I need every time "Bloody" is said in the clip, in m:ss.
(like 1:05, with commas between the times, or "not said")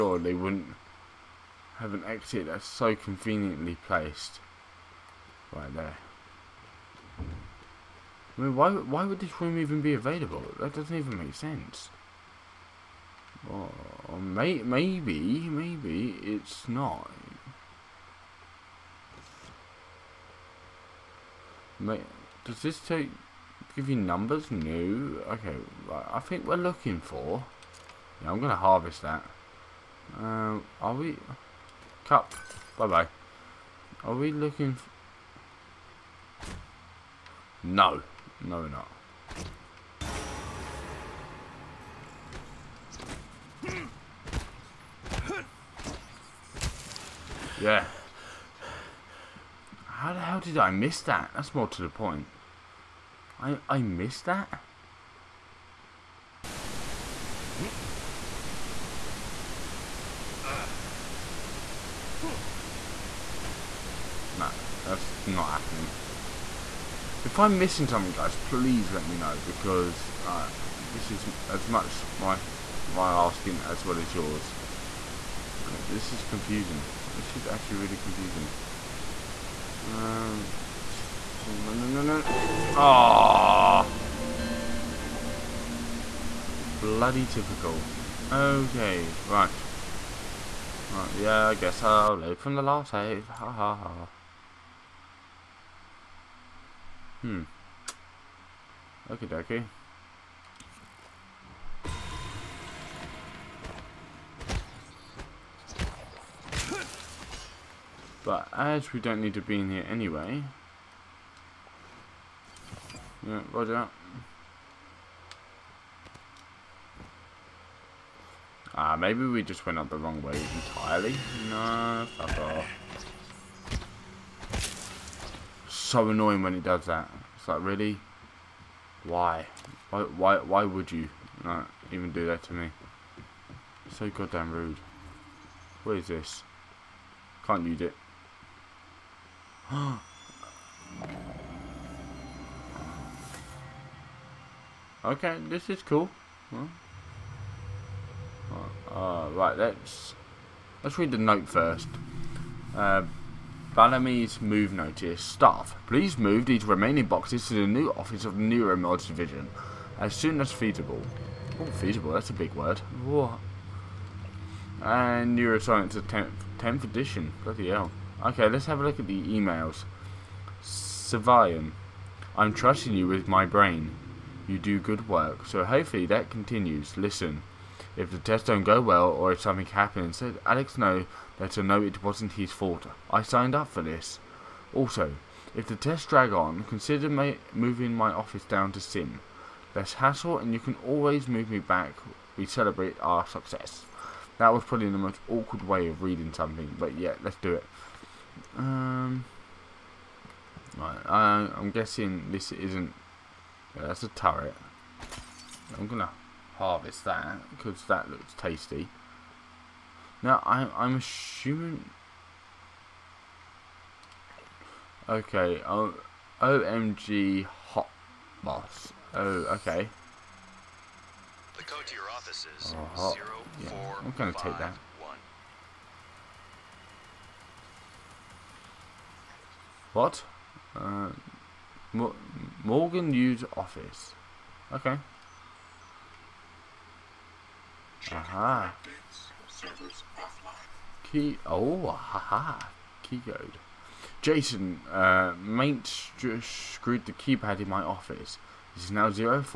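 1:26, 2:47.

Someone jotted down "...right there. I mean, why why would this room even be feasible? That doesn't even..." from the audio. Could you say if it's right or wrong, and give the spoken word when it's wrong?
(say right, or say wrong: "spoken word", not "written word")
wrong: "available", not "feasible".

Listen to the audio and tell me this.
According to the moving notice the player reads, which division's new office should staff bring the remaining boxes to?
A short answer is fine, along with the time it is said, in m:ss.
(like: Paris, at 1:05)
Neuromods Division, at 2:38.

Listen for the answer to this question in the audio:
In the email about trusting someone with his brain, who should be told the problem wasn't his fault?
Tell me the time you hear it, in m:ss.
3:00.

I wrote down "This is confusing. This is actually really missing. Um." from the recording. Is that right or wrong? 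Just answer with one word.
wrong.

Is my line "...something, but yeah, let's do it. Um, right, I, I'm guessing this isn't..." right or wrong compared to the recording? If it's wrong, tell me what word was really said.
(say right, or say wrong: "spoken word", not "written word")
right.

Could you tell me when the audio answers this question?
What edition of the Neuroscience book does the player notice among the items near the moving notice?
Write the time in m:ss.
2:46.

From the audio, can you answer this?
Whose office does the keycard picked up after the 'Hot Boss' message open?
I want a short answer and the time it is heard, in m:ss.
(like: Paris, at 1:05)
Morgan Yu's Office, at 3:52.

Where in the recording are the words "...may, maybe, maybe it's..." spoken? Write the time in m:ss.
0:14.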